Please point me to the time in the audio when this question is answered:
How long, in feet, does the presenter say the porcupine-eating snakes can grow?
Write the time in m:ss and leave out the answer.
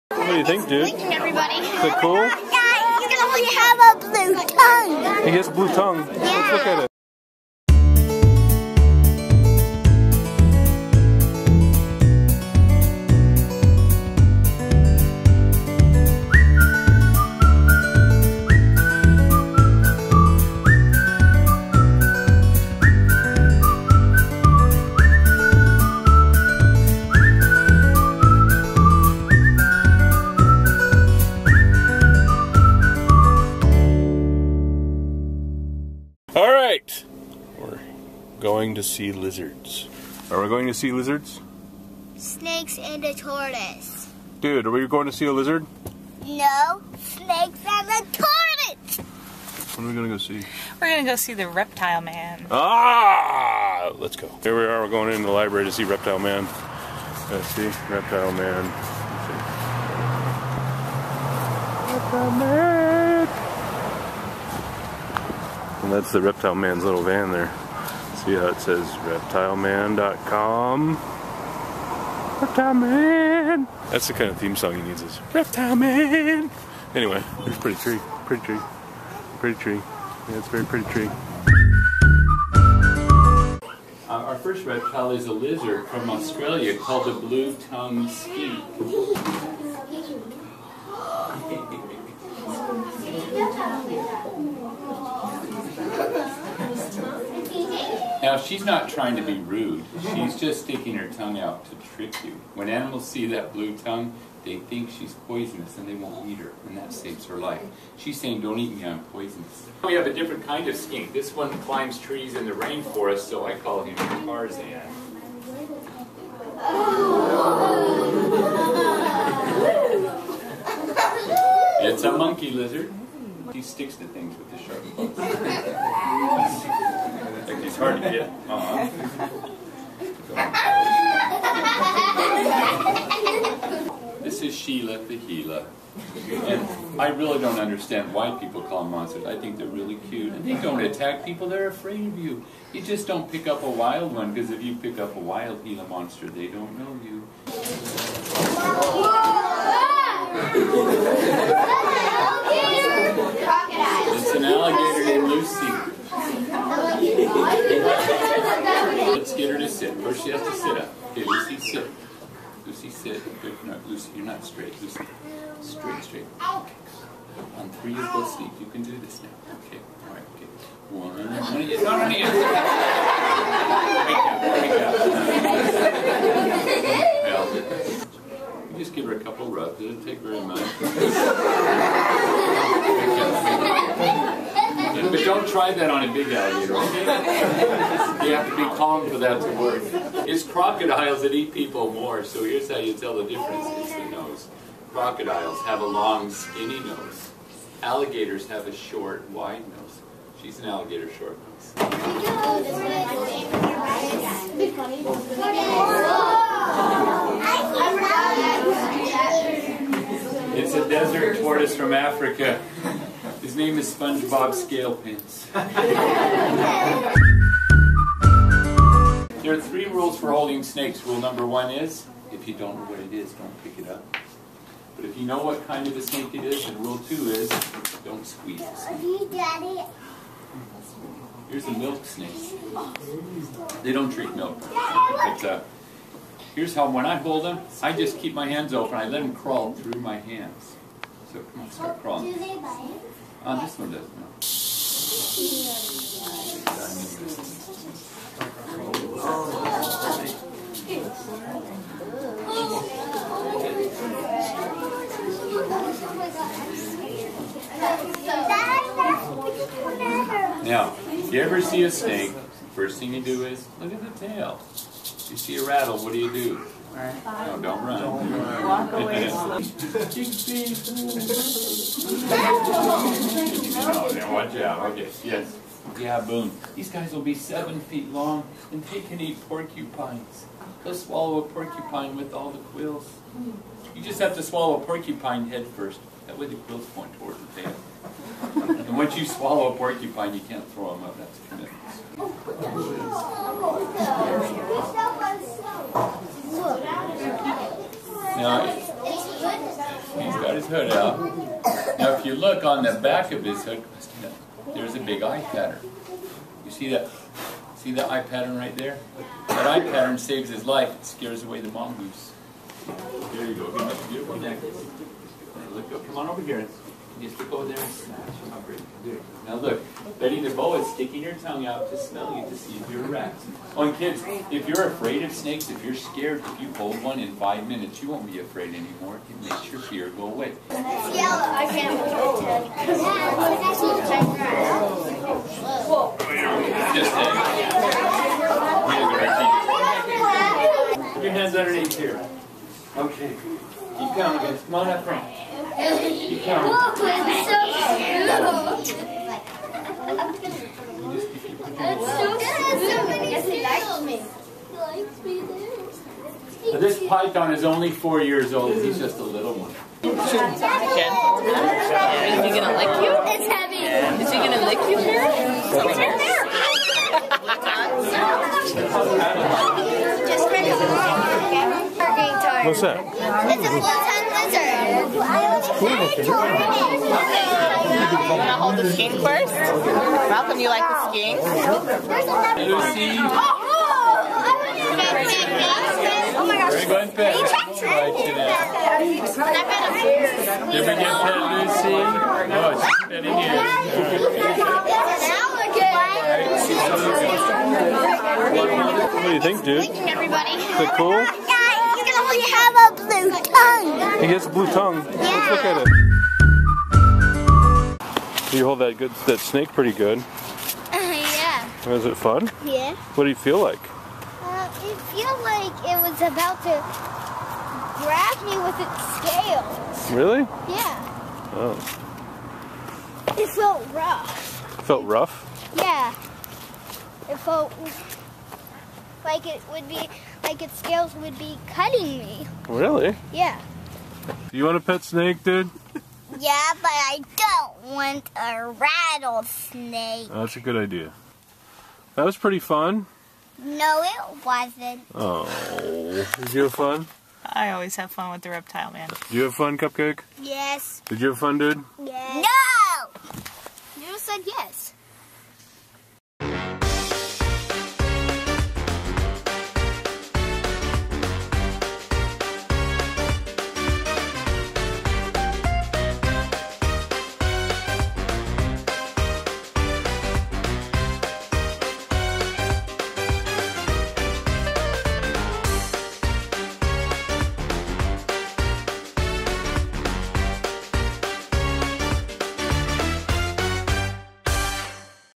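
4:37.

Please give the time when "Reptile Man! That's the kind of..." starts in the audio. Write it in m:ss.
1:12.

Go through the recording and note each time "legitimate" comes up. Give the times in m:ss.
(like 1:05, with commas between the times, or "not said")
not said.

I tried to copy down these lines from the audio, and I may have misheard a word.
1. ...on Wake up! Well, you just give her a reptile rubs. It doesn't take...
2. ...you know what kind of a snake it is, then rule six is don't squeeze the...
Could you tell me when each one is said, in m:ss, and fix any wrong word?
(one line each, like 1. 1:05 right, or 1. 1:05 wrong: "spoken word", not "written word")
1. 2:52 wrong: "couple", not "reptile"
2. 3:45 wrong: "two", not "six".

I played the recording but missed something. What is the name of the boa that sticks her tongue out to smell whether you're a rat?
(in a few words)
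Betty.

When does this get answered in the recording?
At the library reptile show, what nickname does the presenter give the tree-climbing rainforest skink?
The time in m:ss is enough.
1:53.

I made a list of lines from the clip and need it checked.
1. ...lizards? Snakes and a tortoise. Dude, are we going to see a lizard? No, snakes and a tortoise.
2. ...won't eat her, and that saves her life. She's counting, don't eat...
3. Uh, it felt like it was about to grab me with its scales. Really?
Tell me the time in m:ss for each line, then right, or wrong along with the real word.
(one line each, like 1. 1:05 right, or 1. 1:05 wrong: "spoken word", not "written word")
1. 0:40 right
2. 1:45 wrong: "saying", not "counting"
3. 6:54 right.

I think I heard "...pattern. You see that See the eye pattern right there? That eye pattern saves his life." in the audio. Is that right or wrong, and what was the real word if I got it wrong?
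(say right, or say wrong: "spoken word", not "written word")
right.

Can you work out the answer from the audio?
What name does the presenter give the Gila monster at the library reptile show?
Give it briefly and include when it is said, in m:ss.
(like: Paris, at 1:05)
Sheila, at 2:14.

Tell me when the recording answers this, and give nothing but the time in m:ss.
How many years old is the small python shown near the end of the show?
5:57.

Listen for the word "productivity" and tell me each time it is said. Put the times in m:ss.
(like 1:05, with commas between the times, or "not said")
not said.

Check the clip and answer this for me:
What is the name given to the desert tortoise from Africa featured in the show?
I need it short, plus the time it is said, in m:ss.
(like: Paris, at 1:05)
SpongeBob Scalepins, at 3:33.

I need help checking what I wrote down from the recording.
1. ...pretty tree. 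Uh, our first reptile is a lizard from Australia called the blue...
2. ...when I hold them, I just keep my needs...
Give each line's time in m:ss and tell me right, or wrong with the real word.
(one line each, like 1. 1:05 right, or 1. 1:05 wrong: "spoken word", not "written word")
1. 1:20 right
2. 3:56 wrong: "hands", not "needs".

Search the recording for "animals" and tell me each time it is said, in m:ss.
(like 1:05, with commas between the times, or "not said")
1:42.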